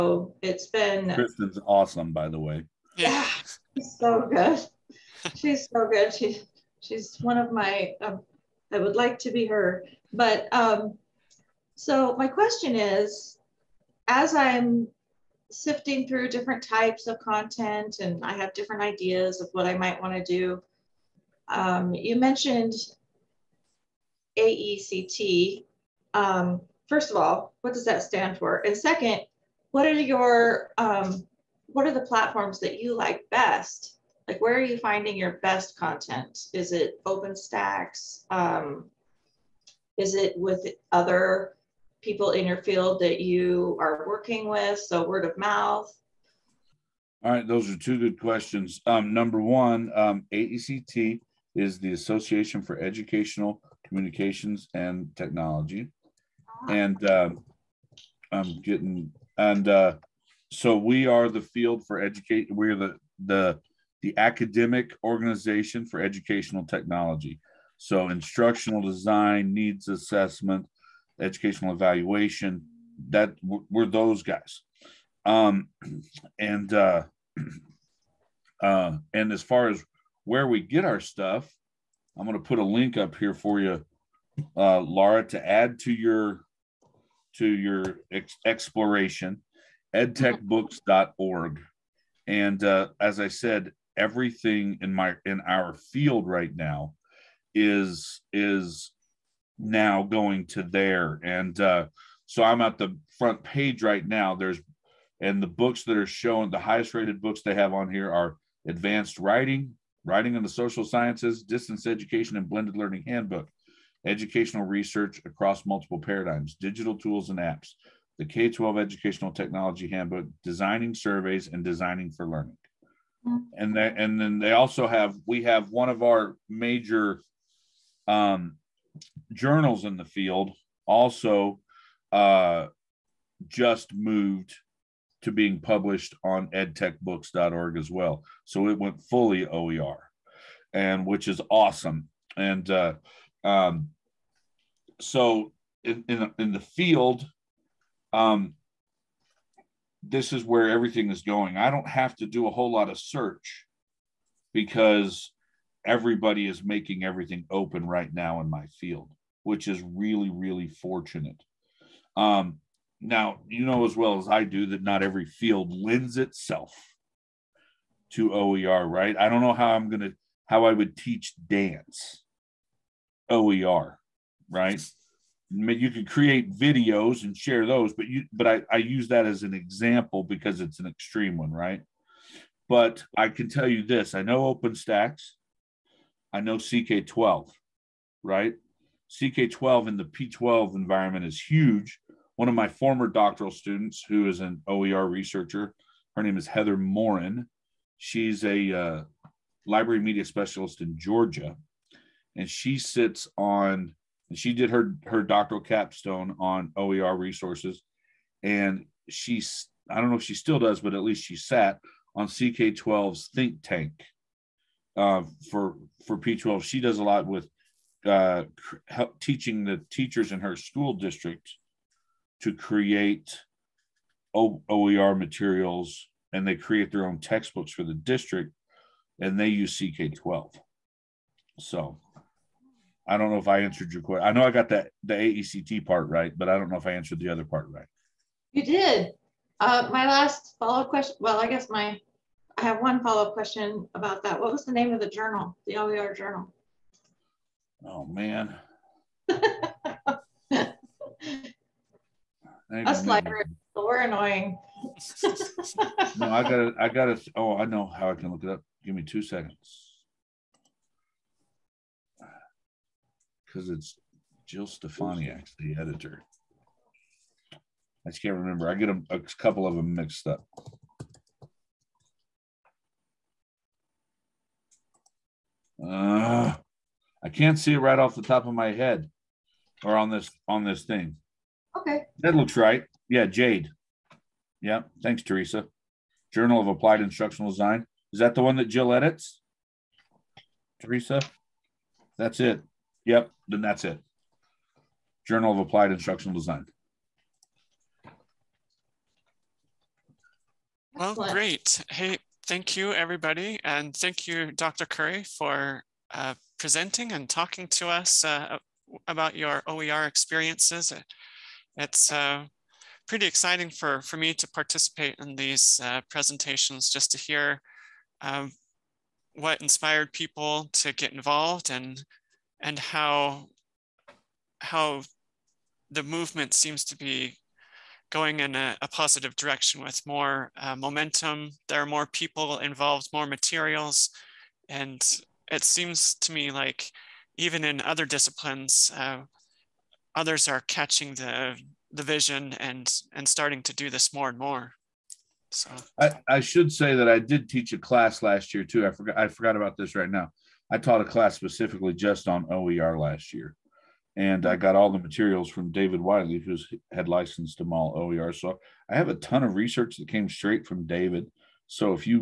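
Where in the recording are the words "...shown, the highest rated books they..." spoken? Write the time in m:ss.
1:46.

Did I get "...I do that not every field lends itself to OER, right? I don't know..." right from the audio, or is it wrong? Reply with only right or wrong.
right.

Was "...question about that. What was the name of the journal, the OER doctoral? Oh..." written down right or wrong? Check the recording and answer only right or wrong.
wrong.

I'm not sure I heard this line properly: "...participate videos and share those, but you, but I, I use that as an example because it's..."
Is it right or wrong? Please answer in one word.
wrong.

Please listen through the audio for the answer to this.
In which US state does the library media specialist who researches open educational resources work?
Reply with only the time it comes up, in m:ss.
3:20.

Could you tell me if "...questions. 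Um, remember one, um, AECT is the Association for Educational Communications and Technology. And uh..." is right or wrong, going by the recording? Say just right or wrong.
wrong.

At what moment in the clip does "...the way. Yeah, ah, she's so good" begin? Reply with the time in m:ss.
0:02.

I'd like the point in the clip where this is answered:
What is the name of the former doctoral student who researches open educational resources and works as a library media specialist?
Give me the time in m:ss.
3:16.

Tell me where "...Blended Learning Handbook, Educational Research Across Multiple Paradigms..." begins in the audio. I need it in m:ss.
1:52.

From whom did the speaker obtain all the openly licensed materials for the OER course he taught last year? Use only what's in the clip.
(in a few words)
David Wiley.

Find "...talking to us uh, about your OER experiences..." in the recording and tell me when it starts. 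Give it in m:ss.
5:07.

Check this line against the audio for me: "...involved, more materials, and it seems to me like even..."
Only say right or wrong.
right.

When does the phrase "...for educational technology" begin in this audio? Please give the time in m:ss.
1:05.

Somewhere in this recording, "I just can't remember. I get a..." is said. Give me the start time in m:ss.
4:28.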